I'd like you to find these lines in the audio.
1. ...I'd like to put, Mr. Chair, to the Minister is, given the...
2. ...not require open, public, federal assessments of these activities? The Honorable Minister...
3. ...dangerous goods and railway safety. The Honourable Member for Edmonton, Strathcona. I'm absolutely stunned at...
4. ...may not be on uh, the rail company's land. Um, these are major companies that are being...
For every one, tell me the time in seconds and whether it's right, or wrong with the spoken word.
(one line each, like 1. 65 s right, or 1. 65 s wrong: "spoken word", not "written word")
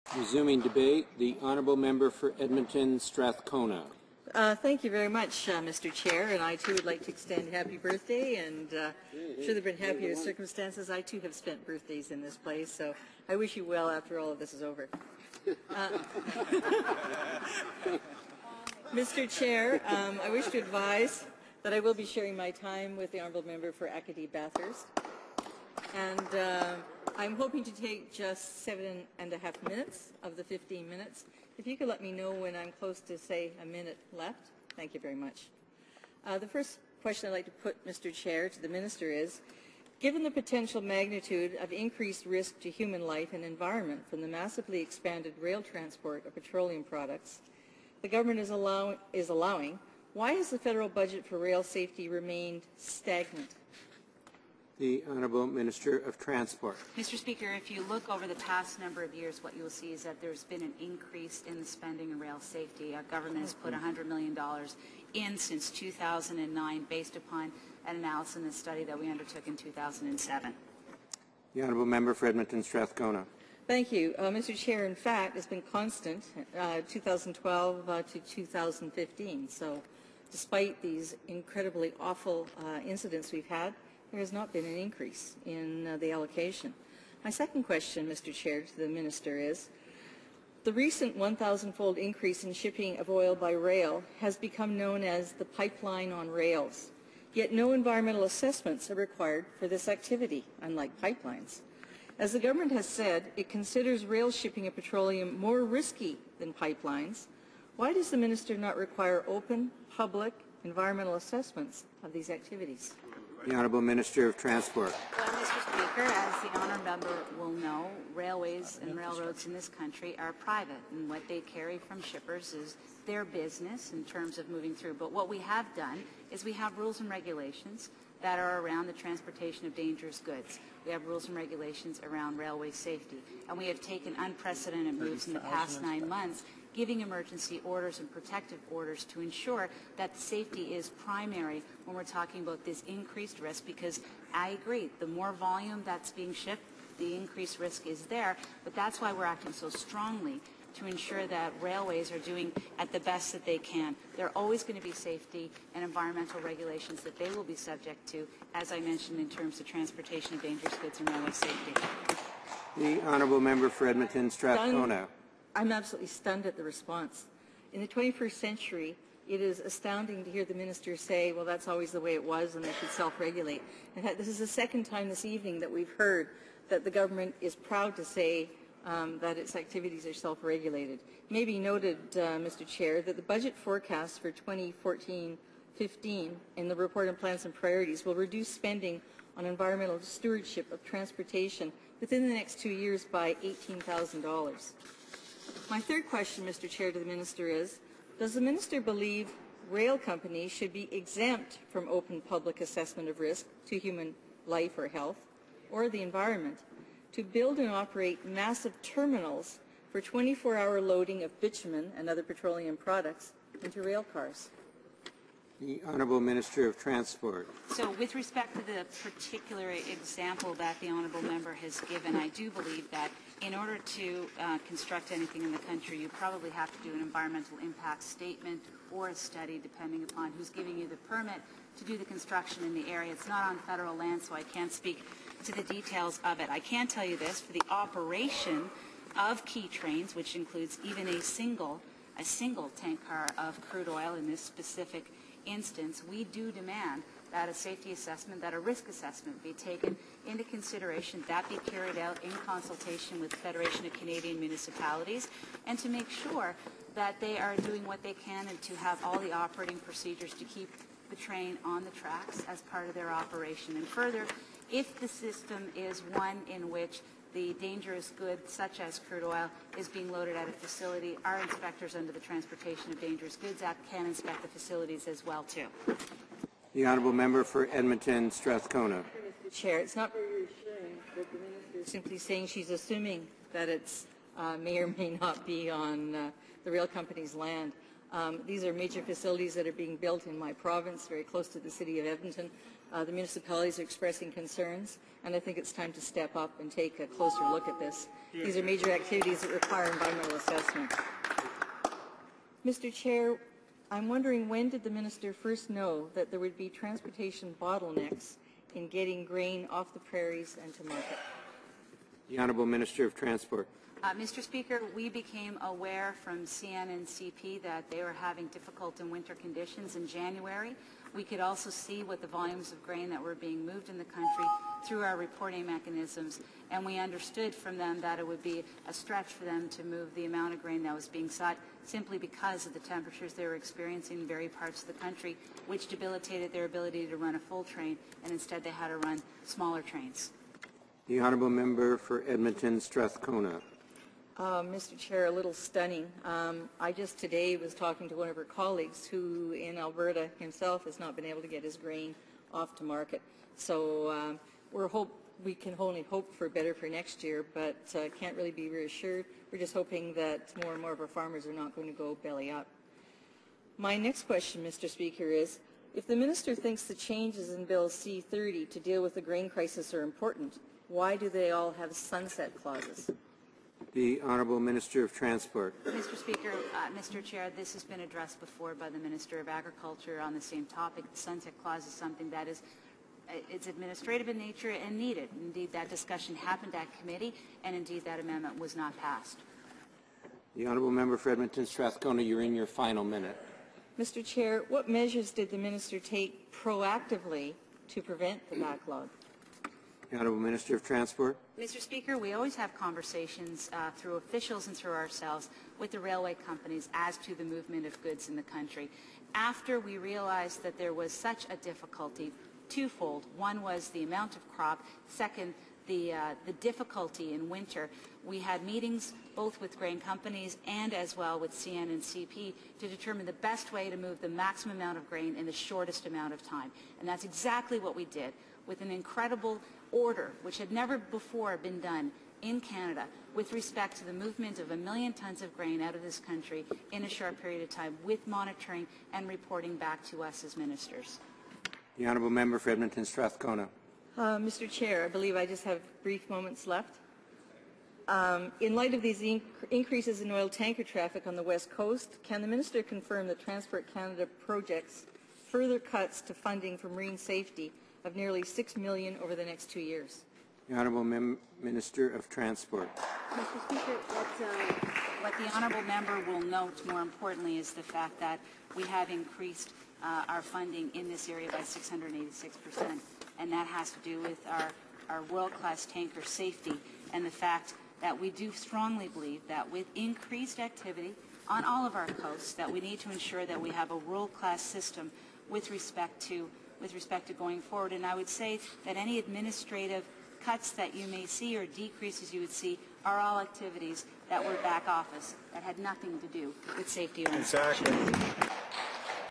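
1. 37 s right
2. 108 s wrong: "environmental", not "federal"
3. 160 s right
4. 284 s wrong: "facilities", not "companies".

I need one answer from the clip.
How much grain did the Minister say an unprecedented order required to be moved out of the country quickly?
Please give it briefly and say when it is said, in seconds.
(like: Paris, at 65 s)
a million tons, at 434 s.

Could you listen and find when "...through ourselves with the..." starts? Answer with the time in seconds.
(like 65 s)
404 s.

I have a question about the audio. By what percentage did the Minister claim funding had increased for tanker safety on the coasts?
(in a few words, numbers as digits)
686 percent.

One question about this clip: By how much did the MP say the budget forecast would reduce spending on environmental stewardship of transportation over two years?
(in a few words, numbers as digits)
$18,000.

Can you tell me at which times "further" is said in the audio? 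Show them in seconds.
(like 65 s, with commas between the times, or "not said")
263 s, 455 s.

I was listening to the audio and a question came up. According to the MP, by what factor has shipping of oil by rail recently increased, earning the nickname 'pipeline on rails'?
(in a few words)
1,000-fold.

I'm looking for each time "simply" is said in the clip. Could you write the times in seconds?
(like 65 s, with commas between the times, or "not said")
281 s, 331 s.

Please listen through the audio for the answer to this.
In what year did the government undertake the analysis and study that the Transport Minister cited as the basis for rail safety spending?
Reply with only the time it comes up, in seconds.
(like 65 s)
69 s.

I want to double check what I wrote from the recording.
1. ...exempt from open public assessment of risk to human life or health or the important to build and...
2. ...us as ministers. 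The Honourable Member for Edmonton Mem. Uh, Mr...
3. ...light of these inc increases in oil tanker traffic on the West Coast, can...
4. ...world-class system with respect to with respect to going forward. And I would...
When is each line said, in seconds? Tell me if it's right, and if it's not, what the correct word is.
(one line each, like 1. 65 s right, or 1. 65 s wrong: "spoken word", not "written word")
1. 200 s wrong: "environment", not "important"
2. 440 s wrong: "Strathcona", not "Mem"
3. 448 s right
4. 483 s right.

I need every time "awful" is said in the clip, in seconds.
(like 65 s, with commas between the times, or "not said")
81 s.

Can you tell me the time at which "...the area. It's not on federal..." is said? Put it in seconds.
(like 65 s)
232 s.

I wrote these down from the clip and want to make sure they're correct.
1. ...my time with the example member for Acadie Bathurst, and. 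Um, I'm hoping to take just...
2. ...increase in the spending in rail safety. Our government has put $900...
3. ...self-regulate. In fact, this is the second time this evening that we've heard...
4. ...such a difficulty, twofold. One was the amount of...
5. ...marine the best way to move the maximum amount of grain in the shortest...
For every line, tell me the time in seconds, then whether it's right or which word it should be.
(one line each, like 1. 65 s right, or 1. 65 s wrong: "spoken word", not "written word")
1. 22 s wrong: "honourable", not "example"
2. 60 s wrong: "100", not "900"
3. 172 s right
4. 411 s right
5. 422 s wrong: "determine", not "marine".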